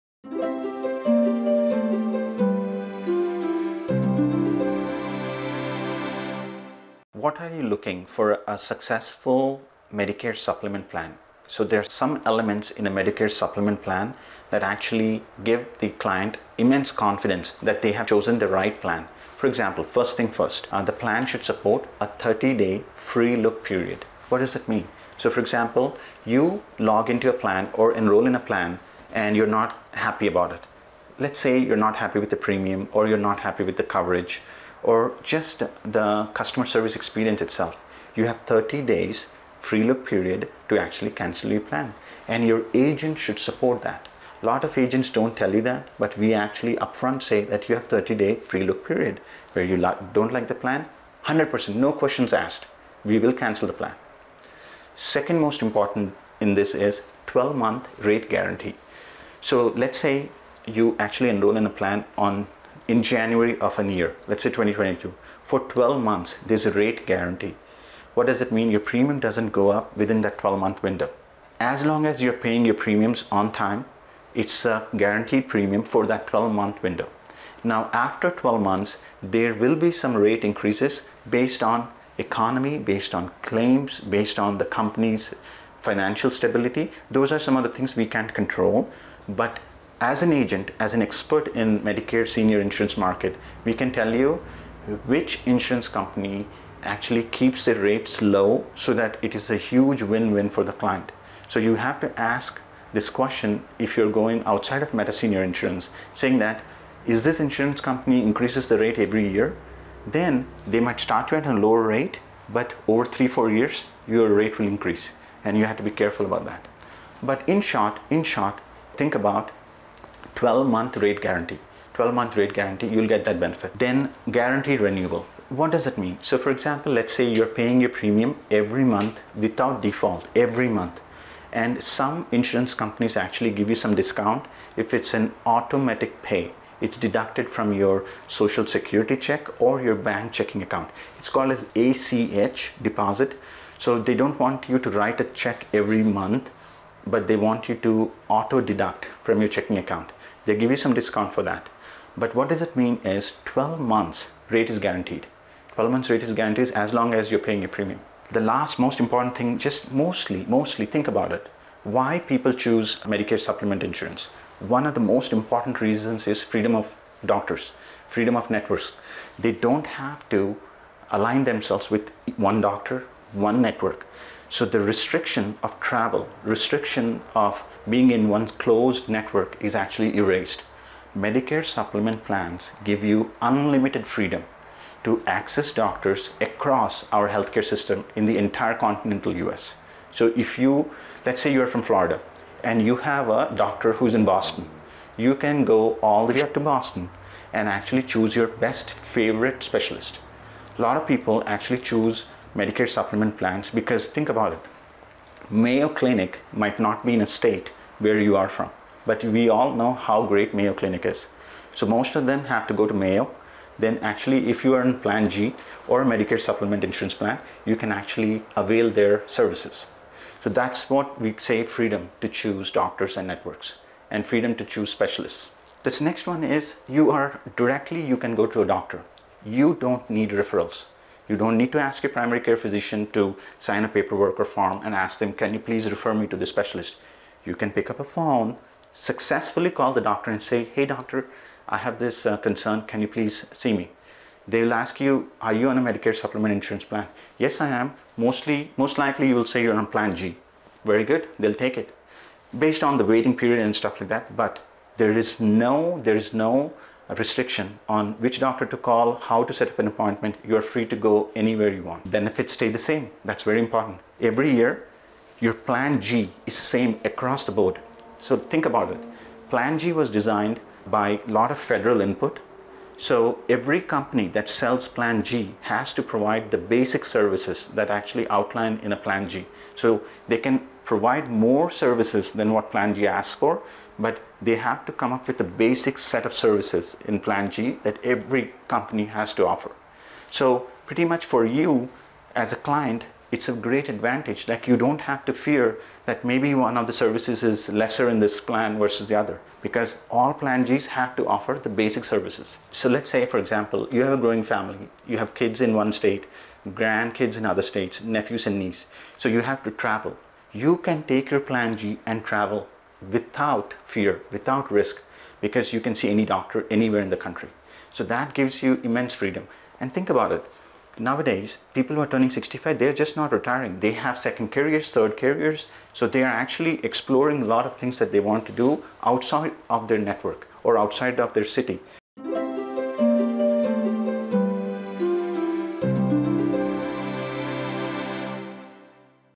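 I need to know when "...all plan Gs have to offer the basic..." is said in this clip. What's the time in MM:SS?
05:00.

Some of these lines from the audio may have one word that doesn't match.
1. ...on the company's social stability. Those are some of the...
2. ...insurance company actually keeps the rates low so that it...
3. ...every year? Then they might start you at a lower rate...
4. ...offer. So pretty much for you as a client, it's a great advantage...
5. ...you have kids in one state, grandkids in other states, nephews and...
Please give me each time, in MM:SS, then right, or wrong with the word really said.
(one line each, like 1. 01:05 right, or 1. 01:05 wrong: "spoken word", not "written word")
1. 01:24 wrong: "financial", not "social"
2. 01:35 right
3. 01:48 right
4. 04:49 right
5. 05:05 right.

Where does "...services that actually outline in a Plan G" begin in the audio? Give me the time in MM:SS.
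04:37.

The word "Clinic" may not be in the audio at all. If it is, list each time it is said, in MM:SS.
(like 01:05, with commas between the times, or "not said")
03:25, 03:30.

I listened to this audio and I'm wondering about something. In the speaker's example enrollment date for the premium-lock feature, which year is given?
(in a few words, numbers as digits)
2022.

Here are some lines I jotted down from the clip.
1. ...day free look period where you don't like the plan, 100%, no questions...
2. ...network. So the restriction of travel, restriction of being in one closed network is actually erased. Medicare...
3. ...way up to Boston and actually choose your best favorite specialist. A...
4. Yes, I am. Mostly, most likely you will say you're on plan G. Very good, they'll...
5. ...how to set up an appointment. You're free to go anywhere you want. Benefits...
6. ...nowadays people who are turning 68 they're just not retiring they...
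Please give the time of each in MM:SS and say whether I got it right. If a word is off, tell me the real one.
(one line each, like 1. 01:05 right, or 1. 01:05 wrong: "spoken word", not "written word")
1. 00:48 right
2. 02:53 right
3. 03:16 right
4. 04:07 right
5. 04:19 right
6. 05:20 wrong: "65", not "68".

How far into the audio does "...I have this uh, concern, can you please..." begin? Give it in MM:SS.
04:01.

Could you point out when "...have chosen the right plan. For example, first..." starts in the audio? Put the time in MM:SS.
00:17.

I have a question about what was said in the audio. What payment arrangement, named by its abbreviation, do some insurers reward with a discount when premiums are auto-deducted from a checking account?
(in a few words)
ACH deposit.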